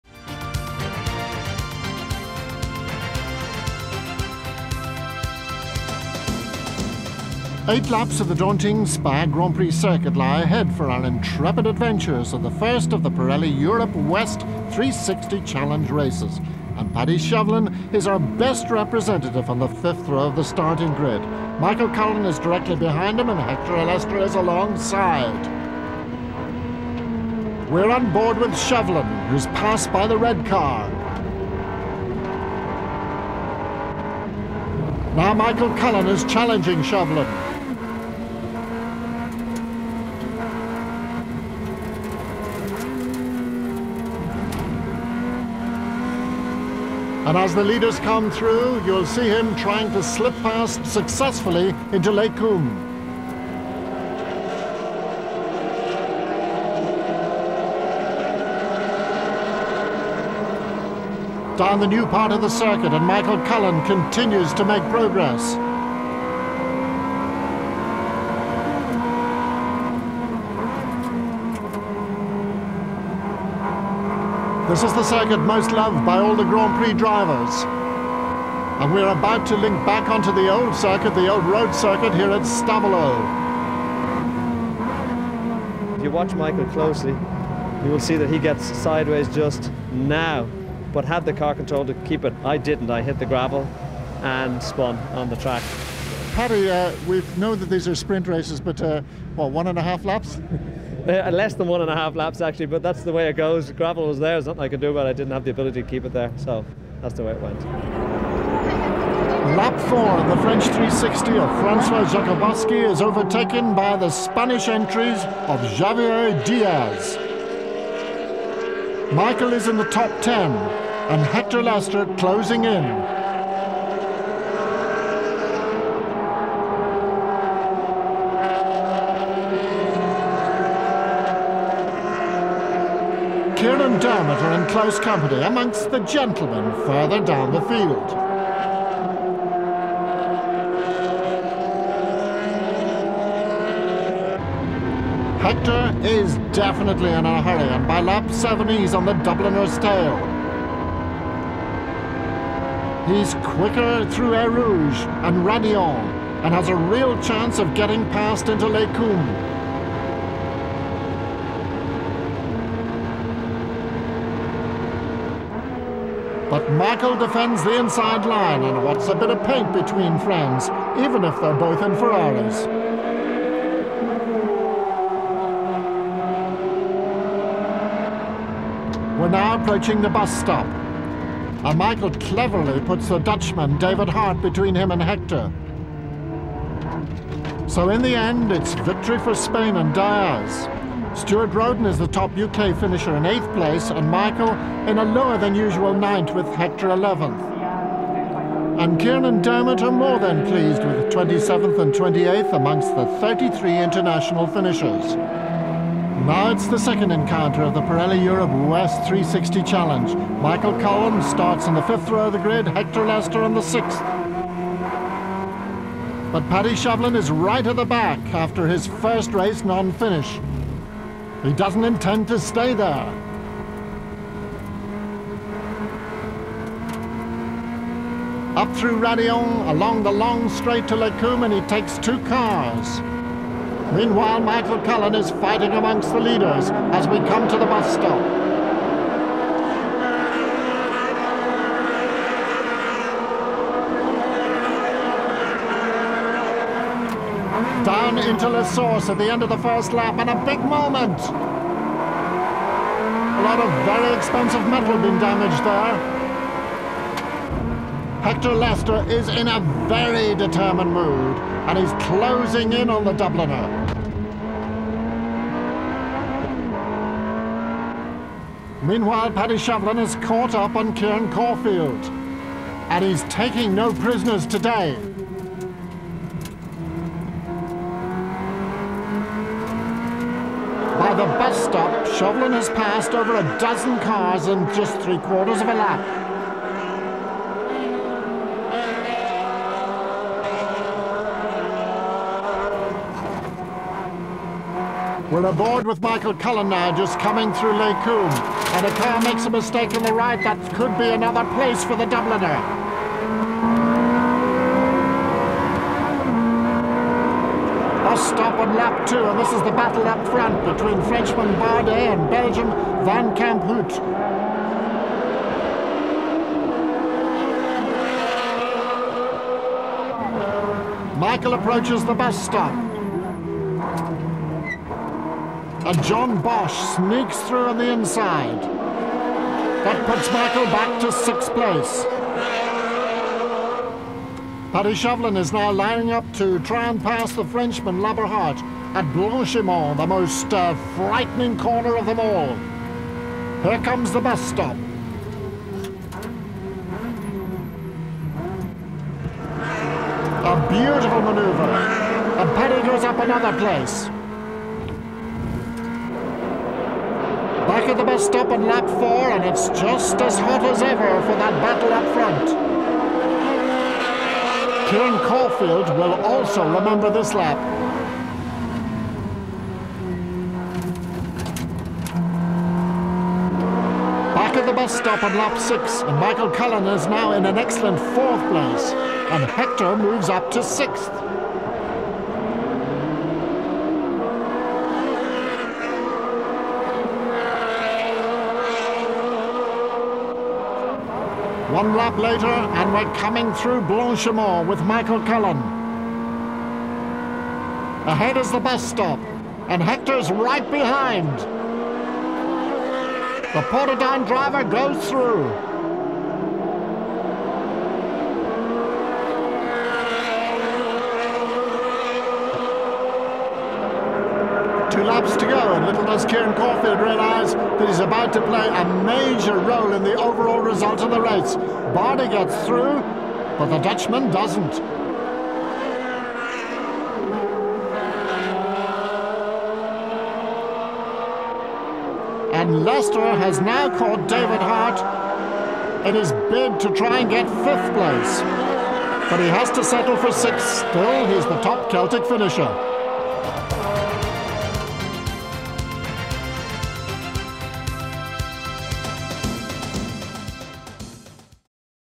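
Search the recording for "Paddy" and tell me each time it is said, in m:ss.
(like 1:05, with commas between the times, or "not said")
0:16, 1:36, 3:36, 4:29, 5:34, 5:52.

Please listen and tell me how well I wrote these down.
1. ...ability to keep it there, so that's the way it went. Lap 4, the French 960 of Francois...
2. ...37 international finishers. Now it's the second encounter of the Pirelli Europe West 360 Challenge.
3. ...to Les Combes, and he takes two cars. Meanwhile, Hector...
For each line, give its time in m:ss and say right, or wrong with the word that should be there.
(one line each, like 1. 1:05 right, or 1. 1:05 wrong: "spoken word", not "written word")
1. 1:45 wrong: "360", not "960"
2. 3:23 wrong: "33", not "37"
3. 3:50 wrong: "Michael", not "Hector".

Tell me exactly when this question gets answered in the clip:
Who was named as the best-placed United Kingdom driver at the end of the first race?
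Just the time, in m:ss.
3:11.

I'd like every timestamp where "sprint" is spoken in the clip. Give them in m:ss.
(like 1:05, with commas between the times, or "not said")
1:37.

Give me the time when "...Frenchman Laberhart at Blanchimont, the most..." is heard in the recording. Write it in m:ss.
5:37.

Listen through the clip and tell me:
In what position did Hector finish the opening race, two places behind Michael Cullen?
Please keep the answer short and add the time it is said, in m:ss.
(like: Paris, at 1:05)
11th, at 3:16.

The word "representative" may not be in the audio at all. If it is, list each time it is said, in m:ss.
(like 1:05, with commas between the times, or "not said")
0:18.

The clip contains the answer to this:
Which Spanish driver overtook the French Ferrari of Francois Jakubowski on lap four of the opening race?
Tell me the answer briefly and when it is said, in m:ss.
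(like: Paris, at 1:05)
Javier Diaz, at 1:55.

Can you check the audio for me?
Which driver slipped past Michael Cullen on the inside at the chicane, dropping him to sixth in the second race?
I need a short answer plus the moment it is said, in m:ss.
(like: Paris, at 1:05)
John Bosch, at 5:26.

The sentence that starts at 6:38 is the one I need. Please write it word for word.
Ahead is the bus stop, and Hector's right behind.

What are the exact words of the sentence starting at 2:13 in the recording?
Dermot are in close company amongst the gentlemen further down the field.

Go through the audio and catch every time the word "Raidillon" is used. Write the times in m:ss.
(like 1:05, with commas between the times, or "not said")
2:35, 3:48.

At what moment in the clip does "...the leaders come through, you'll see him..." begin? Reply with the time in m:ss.
0:47.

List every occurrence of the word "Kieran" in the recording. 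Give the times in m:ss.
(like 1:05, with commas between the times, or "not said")
3:18, 4:30, 6:04, 6:56.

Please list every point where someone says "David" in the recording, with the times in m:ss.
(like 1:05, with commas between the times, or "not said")
3:03, 7:14.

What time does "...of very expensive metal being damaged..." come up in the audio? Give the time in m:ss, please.
4:13.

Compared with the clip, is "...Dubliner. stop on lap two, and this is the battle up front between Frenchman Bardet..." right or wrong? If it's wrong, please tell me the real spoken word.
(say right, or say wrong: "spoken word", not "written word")
right.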